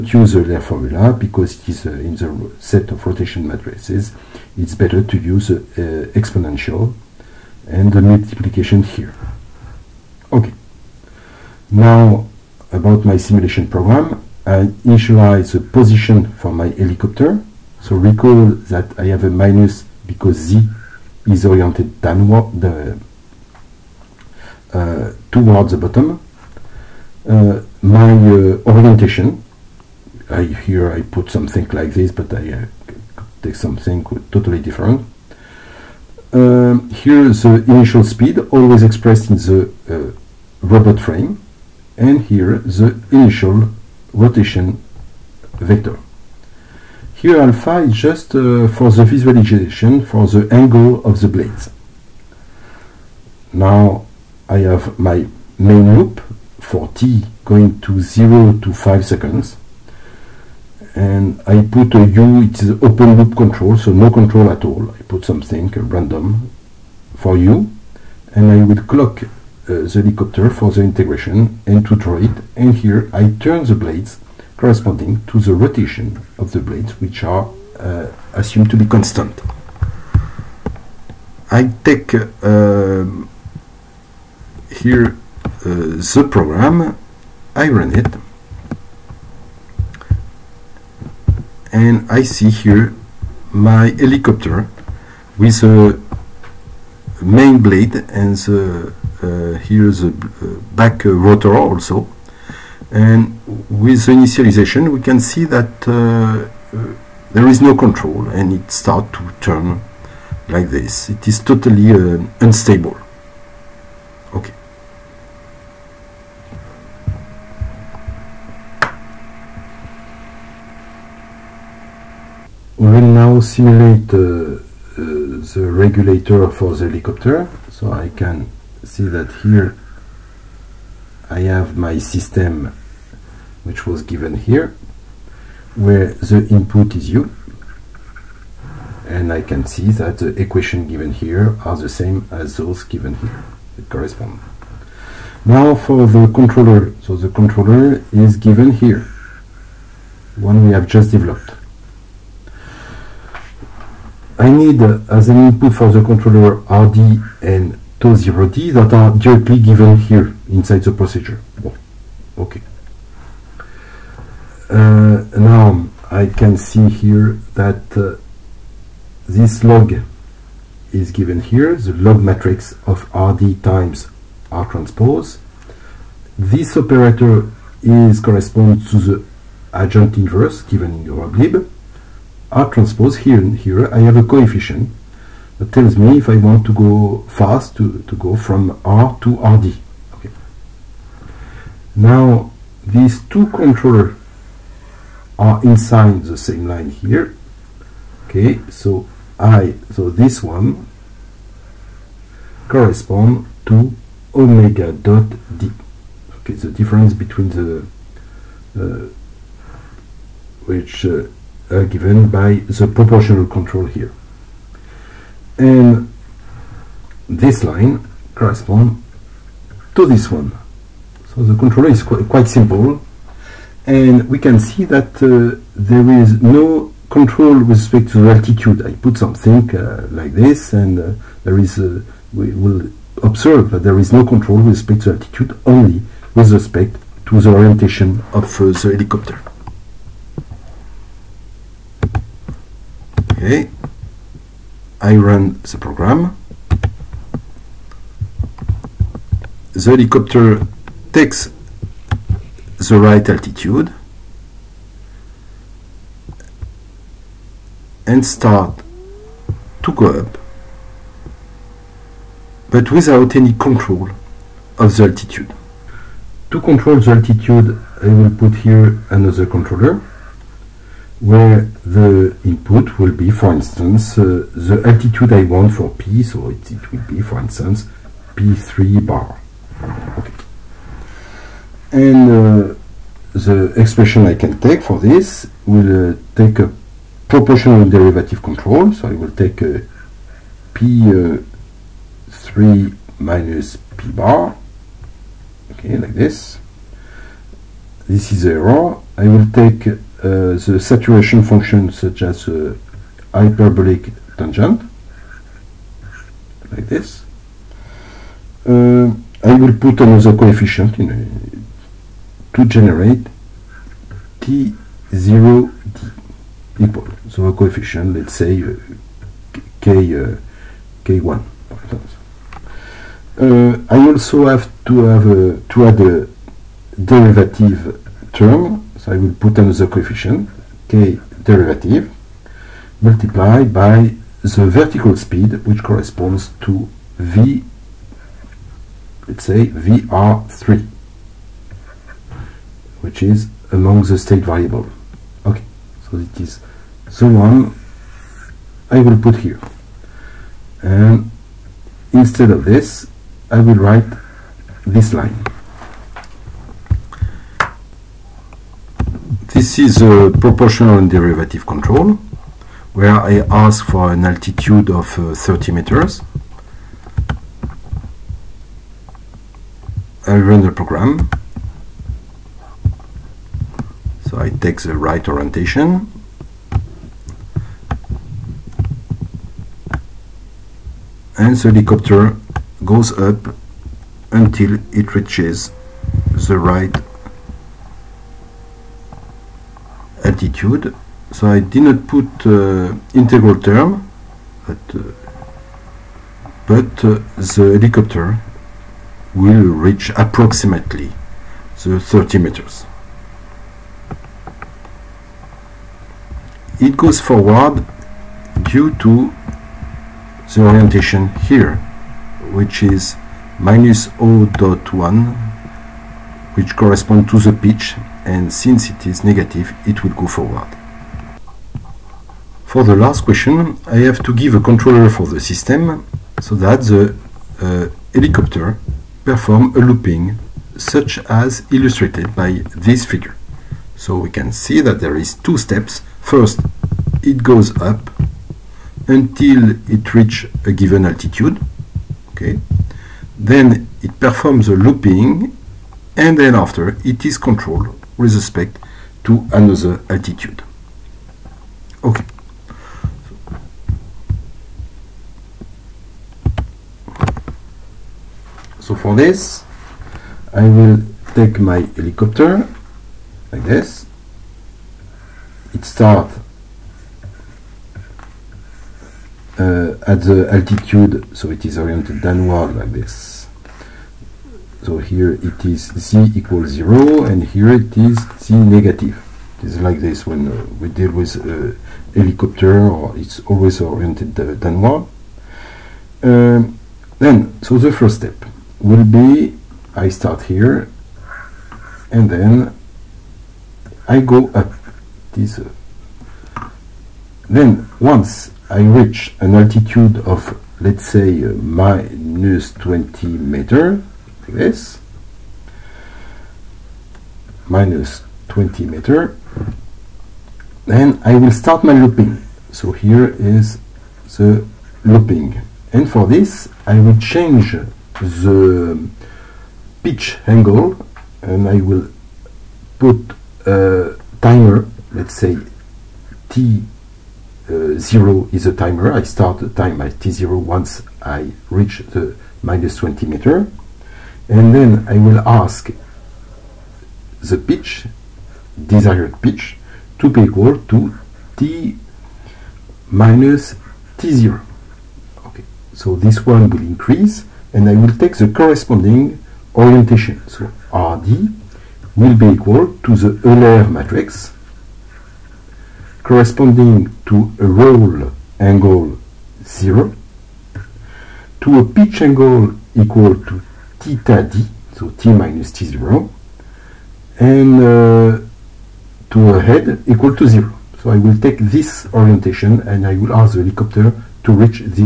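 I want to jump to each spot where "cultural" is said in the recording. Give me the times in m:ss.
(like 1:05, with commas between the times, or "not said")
not said.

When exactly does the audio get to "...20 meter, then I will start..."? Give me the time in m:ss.
8:28.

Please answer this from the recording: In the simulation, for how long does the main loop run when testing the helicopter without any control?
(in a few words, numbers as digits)
5 seconds.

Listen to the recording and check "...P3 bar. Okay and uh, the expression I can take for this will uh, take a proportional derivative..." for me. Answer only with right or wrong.
right.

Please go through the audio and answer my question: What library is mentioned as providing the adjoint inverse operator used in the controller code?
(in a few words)
Euroglib.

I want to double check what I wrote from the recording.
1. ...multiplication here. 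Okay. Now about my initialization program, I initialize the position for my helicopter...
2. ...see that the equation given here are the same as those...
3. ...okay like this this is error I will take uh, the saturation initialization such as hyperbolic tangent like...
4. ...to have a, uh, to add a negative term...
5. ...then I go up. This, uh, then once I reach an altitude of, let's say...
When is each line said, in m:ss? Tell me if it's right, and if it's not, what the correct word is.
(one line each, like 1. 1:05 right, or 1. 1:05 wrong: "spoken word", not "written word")
1. 0:08 wrong: "simulation", not "initialization"
2. 2:19 right
3. 4:55 wrong: "function", not "initialization"
4. 5:24 wrong: "derivative", not "negative"
5. 8:12 right.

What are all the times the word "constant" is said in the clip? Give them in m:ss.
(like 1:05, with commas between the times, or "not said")
1:18.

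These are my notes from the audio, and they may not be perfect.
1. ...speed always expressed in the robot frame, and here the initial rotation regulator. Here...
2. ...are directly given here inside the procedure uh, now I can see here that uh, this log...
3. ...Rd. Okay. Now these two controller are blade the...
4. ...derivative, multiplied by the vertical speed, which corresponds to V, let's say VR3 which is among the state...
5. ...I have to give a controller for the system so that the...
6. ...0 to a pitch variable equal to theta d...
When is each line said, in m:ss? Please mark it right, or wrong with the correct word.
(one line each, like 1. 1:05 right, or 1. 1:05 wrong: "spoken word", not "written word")
1. 0:38 wrong: "vector", not "regulator"
2. 2:38 right
3. 3:09 wrong: "inside", not "blade"
4. 5:31 right
5. 7:03 right
6. 9:19 wrong: "angle", not "variable".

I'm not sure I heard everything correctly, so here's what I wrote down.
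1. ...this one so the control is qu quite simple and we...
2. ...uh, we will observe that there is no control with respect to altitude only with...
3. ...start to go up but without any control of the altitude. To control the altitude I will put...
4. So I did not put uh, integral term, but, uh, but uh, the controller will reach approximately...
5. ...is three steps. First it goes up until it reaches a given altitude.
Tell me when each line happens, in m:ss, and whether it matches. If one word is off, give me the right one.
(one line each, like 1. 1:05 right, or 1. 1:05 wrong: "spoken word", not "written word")
1. 3:40 right
2. 3:51 right
3. 4:18 right
4. 6:31 wrong: "helicopter", not "controller"
5. 7:15 wrong: "two", not "three".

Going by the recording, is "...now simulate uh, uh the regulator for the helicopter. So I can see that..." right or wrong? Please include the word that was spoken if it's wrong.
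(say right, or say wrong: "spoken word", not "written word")
right.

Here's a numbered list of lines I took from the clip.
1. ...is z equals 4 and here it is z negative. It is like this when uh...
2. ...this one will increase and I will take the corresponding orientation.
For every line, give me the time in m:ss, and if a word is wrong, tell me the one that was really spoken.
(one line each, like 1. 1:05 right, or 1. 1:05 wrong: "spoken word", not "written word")
1. 7:55 wrong: "0", not "4"
2. 9:06 right.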